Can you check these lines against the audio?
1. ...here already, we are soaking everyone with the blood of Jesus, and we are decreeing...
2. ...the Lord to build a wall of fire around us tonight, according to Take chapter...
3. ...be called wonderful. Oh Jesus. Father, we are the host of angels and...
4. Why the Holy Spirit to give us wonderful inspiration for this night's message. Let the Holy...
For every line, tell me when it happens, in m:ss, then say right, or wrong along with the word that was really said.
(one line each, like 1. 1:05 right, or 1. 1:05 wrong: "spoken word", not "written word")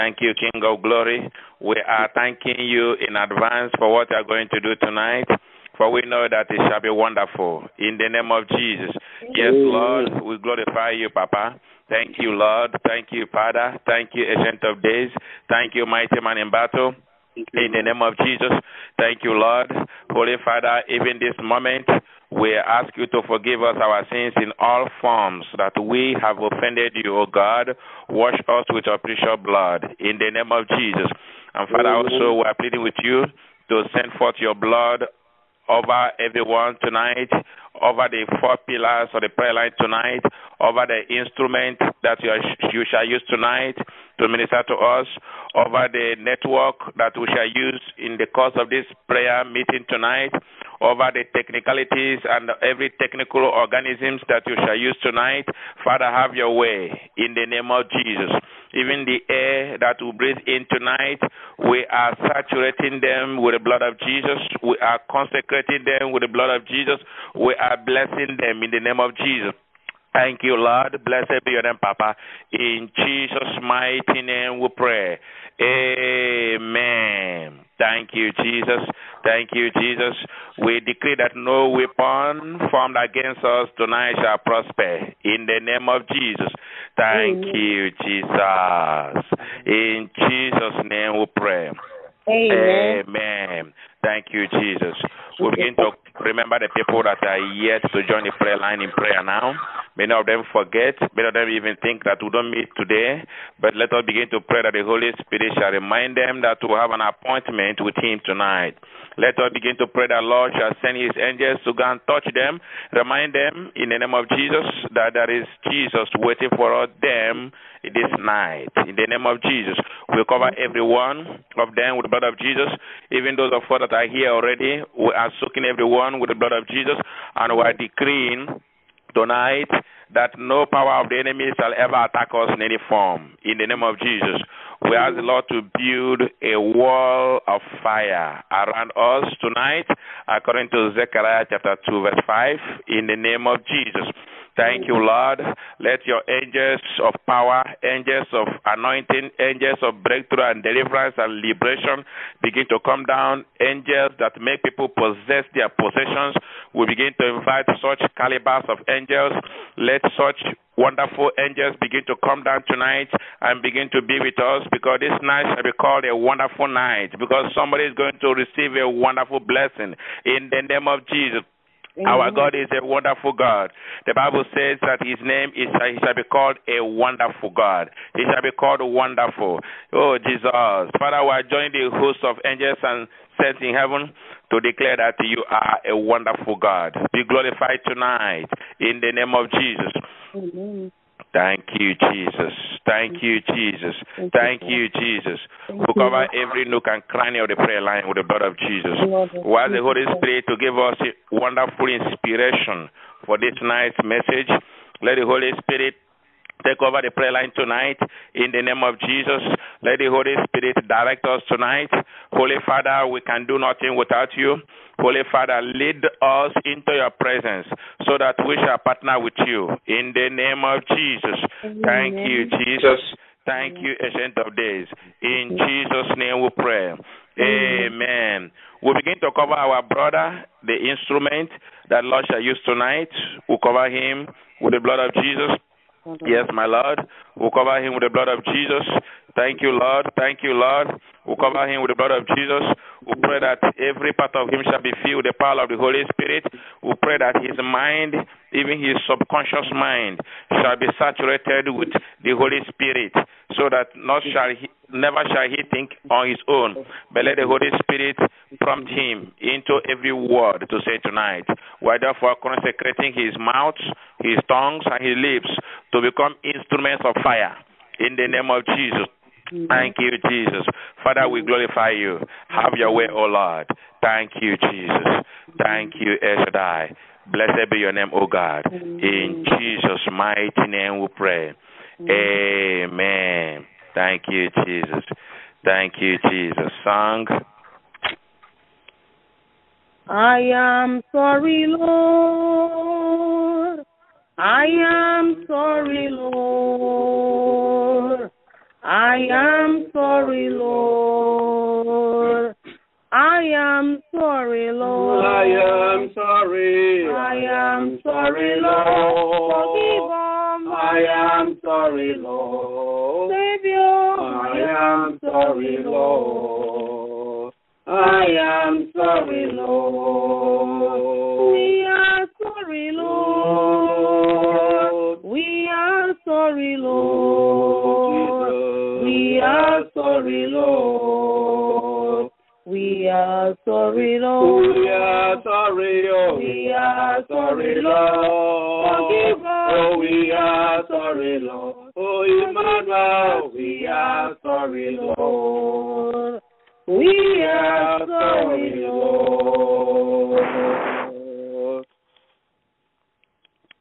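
1. 2:04 right
2. 2:15 wrong: "Zechariah", not "Take"
3. 2:58 right
4. 3:19 right.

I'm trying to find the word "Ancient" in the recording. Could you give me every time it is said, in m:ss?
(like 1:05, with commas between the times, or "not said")
0:14, 3:44.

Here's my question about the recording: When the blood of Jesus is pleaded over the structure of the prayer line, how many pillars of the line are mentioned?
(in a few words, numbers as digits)
4.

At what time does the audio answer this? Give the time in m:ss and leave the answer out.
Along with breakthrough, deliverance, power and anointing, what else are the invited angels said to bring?
2:31.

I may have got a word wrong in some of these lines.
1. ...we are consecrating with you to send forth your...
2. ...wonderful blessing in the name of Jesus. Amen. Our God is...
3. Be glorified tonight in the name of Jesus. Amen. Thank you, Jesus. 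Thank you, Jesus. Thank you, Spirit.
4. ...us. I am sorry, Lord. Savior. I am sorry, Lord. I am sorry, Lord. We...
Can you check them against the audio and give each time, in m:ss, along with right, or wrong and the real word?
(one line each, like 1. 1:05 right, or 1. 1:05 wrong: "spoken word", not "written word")
1. 0:32 wrong: "pleading", not "consecrating"
2. 2:48 right
3. 3:07 wrong: "Jesus", not "Spirit"
4. 5:10 right.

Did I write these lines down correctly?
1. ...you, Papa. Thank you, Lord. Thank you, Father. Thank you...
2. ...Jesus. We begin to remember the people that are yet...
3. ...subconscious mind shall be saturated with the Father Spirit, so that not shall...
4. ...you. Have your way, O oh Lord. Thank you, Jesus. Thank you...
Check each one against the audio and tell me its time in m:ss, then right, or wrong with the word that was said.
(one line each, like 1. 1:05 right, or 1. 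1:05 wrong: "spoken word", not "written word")
1. 0:10 right
2. 1:34 right
3. 4:09 wrong: "Holy", not "Father"
4. 4:31 right.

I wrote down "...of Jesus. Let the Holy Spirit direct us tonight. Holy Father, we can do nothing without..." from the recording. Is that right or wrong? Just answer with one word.
right.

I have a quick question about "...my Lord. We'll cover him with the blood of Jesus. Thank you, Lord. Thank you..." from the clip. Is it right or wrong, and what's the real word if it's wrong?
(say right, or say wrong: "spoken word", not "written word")
right.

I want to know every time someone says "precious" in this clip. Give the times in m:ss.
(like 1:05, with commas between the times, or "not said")
0:28.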